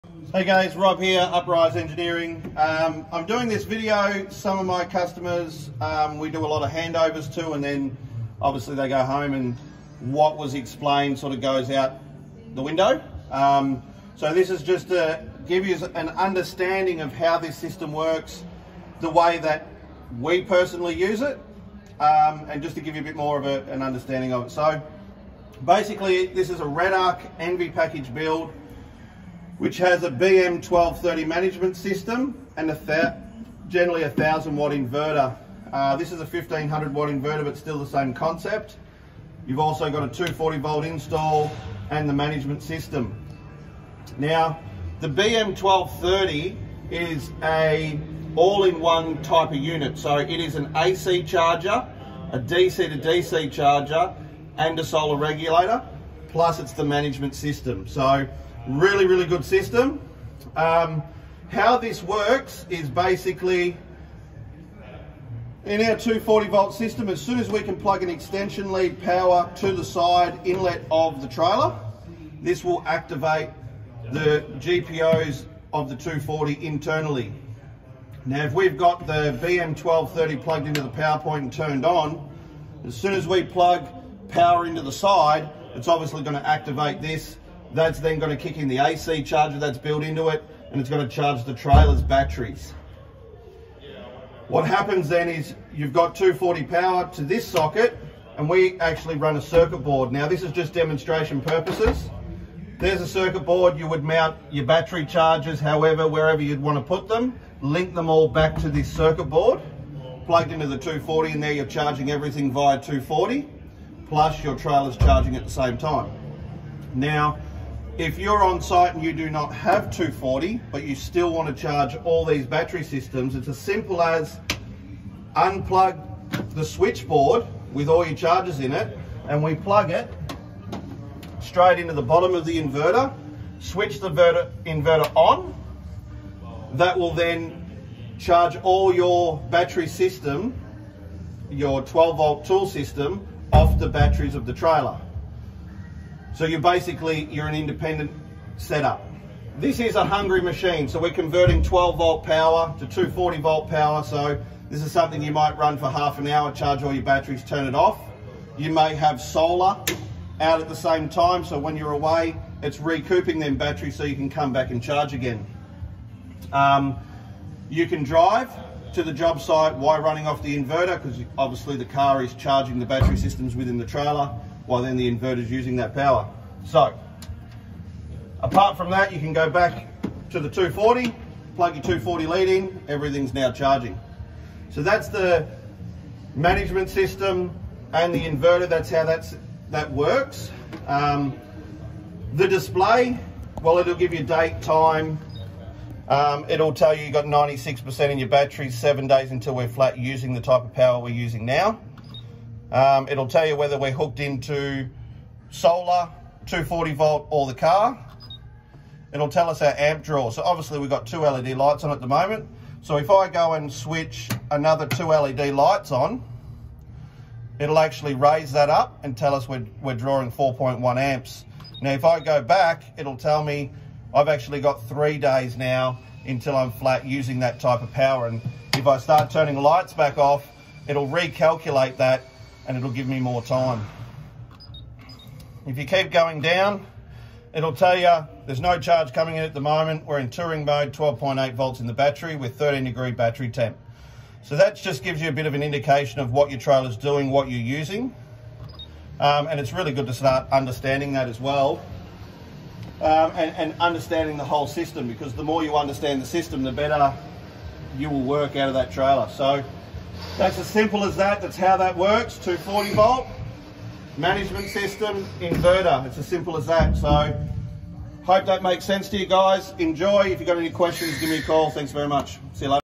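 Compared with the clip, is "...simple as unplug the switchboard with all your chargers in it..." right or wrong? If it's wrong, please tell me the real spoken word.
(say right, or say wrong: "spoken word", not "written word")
right.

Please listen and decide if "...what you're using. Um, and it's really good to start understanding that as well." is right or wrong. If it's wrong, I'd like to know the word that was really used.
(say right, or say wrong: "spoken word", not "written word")
right.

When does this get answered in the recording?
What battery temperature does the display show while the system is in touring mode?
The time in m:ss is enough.
4:02.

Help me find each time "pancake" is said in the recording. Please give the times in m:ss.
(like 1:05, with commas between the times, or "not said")
not said.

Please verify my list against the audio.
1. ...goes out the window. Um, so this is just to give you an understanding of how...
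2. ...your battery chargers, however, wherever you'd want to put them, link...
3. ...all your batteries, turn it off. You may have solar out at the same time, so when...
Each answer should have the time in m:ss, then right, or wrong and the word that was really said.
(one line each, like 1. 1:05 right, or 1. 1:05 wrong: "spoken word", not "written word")
1. 0:11 right
2. 1:44 right
3. 2:36 right.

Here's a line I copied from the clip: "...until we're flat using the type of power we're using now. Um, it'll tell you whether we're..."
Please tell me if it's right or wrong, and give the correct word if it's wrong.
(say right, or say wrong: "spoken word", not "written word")
right.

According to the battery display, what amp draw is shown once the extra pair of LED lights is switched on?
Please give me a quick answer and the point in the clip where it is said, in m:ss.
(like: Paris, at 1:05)
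4.1 amps, at 3:40.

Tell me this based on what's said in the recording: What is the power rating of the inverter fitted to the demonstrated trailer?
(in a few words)
1500 watt.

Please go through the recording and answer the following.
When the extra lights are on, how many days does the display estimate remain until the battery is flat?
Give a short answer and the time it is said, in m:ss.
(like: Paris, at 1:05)
3 days, at 3:44.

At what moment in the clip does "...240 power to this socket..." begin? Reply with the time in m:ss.
1:36.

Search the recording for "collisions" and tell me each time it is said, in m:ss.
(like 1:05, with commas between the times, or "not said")
not said.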